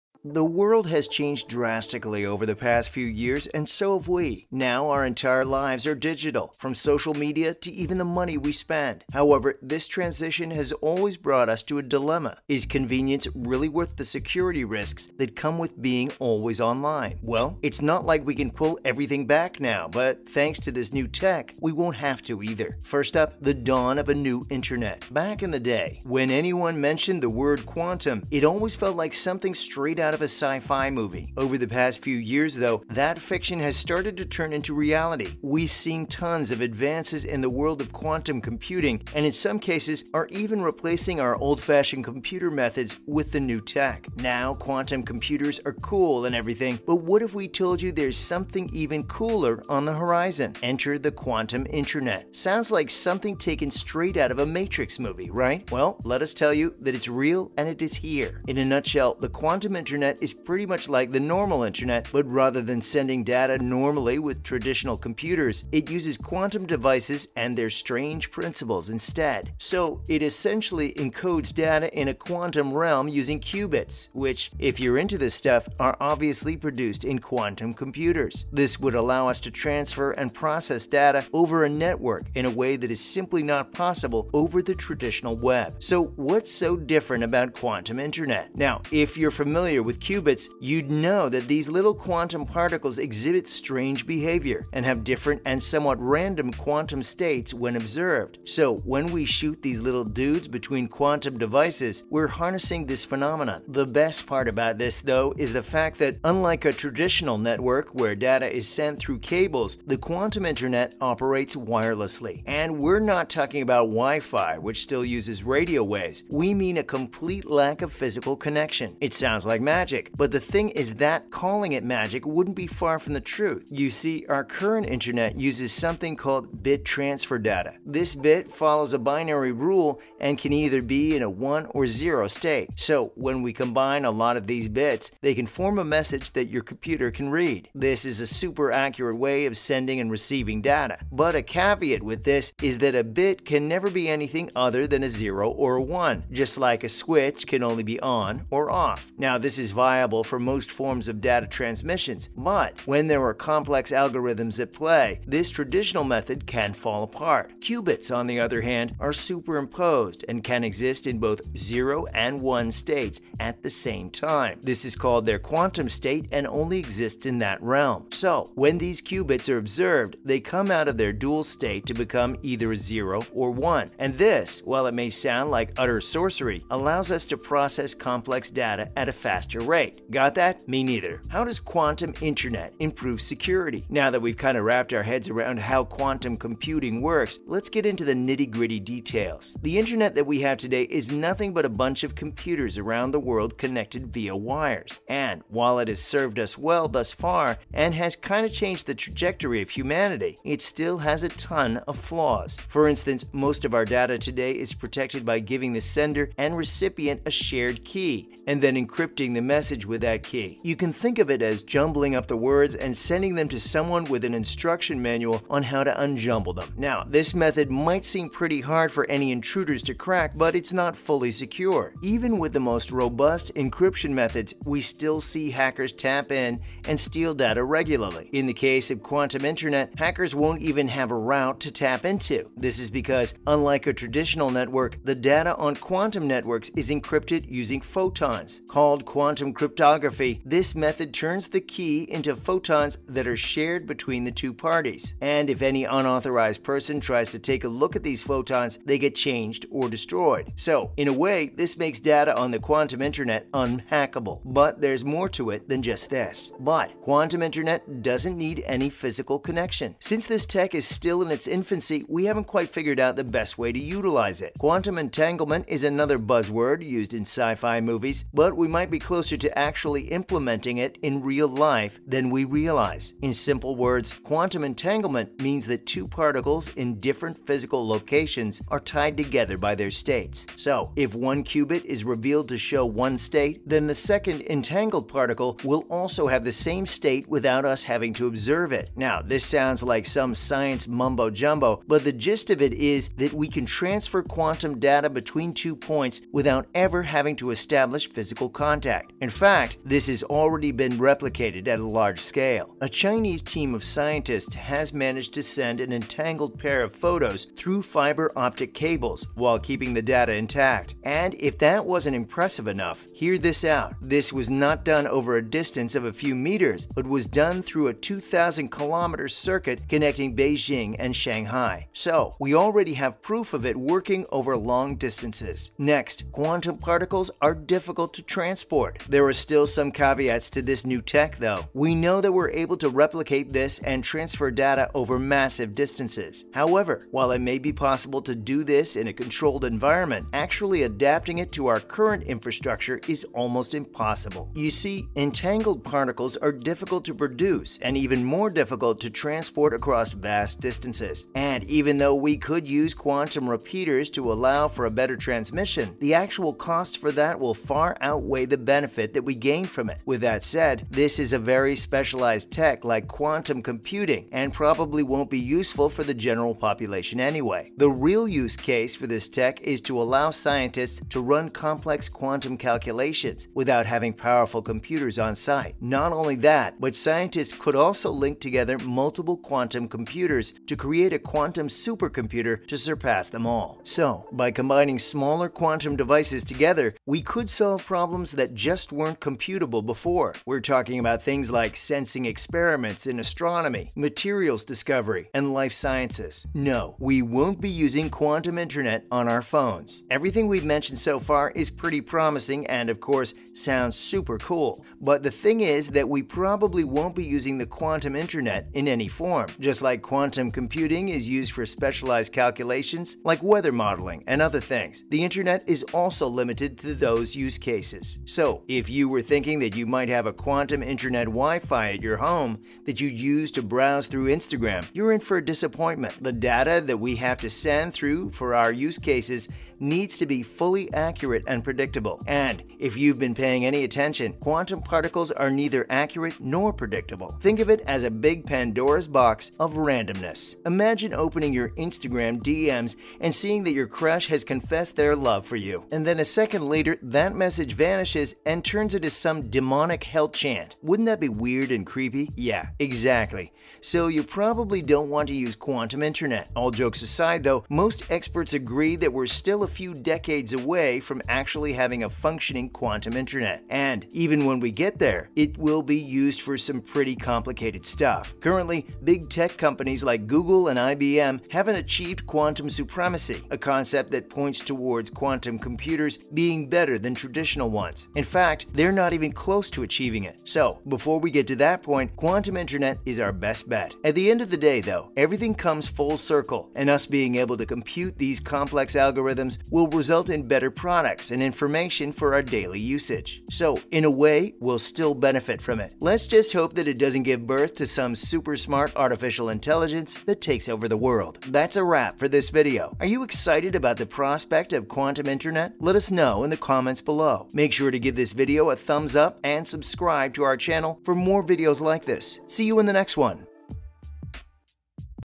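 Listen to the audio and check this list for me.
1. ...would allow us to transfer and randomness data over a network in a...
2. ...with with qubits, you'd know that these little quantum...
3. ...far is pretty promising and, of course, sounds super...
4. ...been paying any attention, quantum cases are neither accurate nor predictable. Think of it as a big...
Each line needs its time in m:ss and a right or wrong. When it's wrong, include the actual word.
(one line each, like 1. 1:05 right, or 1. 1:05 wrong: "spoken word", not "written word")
1. 1:18 wrong: "process", not "randomness"
2. 1:29 right
3. 6:41 right
4. 7:13 wrong: "particles", not "cases".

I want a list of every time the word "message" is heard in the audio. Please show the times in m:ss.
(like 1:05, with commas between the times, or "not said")
2:15, 3:29, 7:27.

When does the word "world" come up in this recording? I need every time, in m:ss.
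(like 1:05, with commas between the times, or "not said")
0:00, 0:37, 3:13, 8:21.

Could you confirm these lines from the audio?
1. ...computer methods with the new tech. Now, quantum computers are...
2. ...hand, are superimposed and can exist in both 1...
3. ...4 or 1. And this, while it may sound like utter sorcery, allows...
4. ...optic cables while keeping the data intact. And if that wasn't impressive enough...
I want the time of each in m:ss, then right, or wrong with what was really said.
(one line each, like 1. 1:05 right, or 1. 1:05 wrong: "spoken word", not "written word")
1. 0:42 right
2. 2:38 wrong: "0", not "1"
3. 2:52 wrong: "0", not "4"
4. 5:08 right.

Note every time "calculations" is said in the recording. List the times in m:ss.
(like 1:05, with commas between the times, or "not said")
6:12, 6:52.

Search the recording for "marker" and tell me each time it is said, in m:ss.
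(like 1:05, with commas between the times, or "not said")
not said.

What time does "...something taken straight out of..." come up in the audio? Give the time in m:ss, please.
0:52.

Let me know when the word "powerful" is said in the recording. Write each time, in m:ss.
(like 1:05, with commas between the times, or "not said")
6:14.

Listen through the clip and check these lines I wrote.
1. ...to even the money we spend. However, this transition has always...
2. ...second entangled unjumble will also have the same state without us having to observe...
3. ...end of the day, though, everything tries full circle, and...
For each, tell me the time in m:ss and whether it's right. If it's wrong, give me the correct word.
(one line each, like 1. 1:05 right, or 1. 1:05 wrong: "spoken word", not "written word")
1. 0:07 right
2. 4:43 wrong: "particle", not "unjumble"
3. 8:04 wrong: "comes", not "tries".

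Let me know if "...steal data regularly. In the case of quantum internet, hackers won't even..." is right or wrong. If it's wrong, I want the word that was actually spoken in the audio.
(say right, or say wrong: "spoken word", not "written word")
right.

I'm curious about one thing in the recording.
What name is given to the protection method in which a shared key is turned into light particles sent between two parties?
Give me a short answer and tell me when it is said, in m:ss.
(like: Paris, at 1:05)
Quantum cryptography, at 3:59.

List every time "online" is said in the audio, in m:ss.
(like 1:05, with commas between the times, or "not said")
0:16.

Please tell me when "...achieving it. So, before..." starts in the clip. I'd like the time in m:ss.
7:59.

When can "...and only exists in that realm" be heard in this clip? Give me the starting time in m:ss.
2:46.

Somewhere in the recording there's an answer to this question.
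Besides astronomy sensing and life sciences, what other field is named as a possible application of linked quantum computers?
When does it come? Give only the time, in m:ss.
6:33.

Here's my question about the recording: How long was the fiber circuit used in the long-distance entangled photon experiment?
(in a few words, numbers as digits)
2,000 kilometers.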